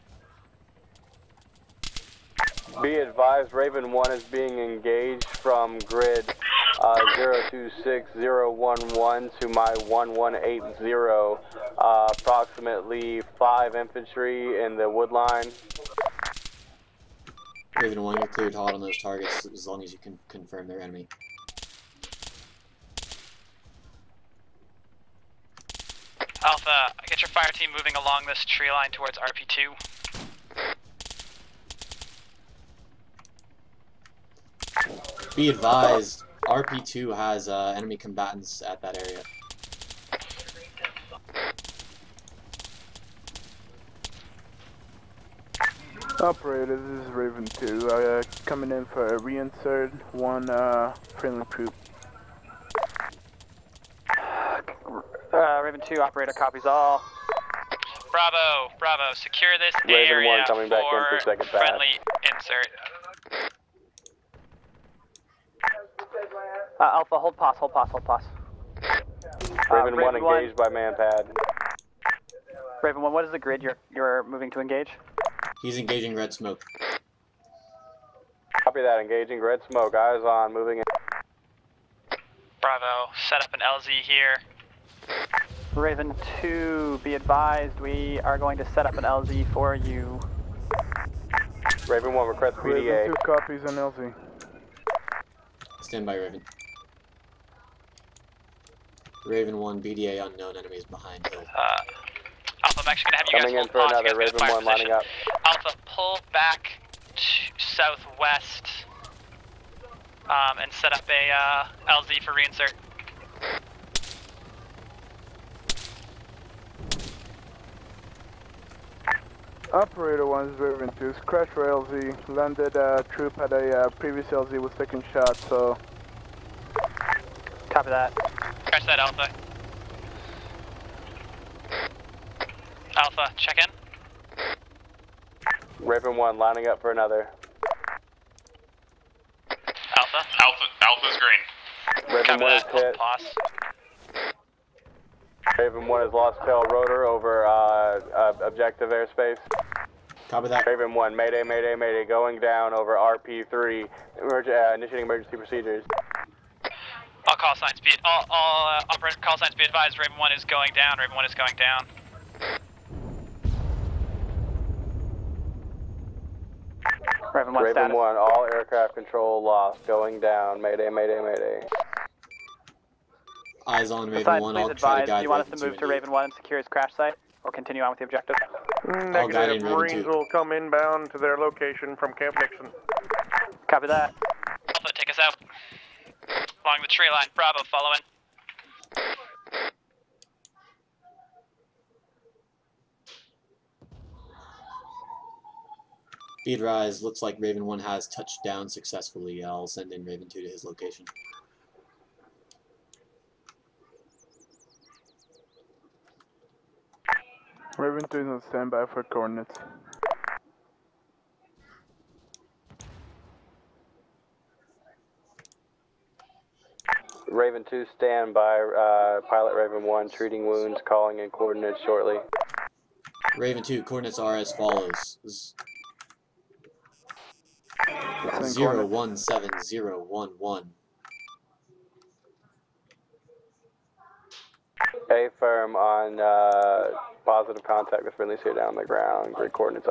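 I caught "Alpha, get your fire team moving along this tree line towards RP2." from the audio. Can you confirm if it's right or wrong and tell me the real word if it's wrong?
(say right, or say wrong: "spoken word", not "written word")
right.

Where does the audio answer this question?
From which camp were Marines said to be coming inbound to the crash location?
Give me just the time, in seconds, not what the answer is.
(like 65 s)
182 s.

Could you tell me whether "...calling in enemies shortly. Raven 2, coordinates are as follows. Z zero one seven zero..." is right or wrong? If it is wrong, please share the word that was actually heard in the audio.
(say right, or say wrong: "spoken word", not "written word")
wrong: "coordinates", not "enemies".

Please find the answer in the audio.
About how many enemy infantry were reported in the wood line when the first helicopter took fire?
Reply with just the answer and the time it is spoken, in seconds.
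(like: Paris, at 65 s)
5, at 12 s.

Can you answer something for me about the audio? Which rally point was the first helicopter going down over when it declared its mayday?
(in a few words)
RP3.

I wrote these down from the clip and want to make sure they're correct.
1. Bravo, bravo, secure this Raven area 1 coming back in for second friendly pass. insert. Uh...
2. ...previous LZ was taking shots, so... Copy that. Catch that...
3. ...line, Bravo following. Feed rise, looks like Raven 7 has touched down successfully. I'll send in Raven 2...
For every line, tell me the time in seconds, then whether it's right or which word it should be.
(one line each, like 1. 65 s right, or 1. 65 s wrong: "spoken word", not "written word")
1. 58 s right
2. 123 s right
3. 187 s wrong: "1", not "7".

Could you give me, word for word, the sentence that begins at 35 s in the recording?
Be advised, RP2 has uh, enemy combatants at that area.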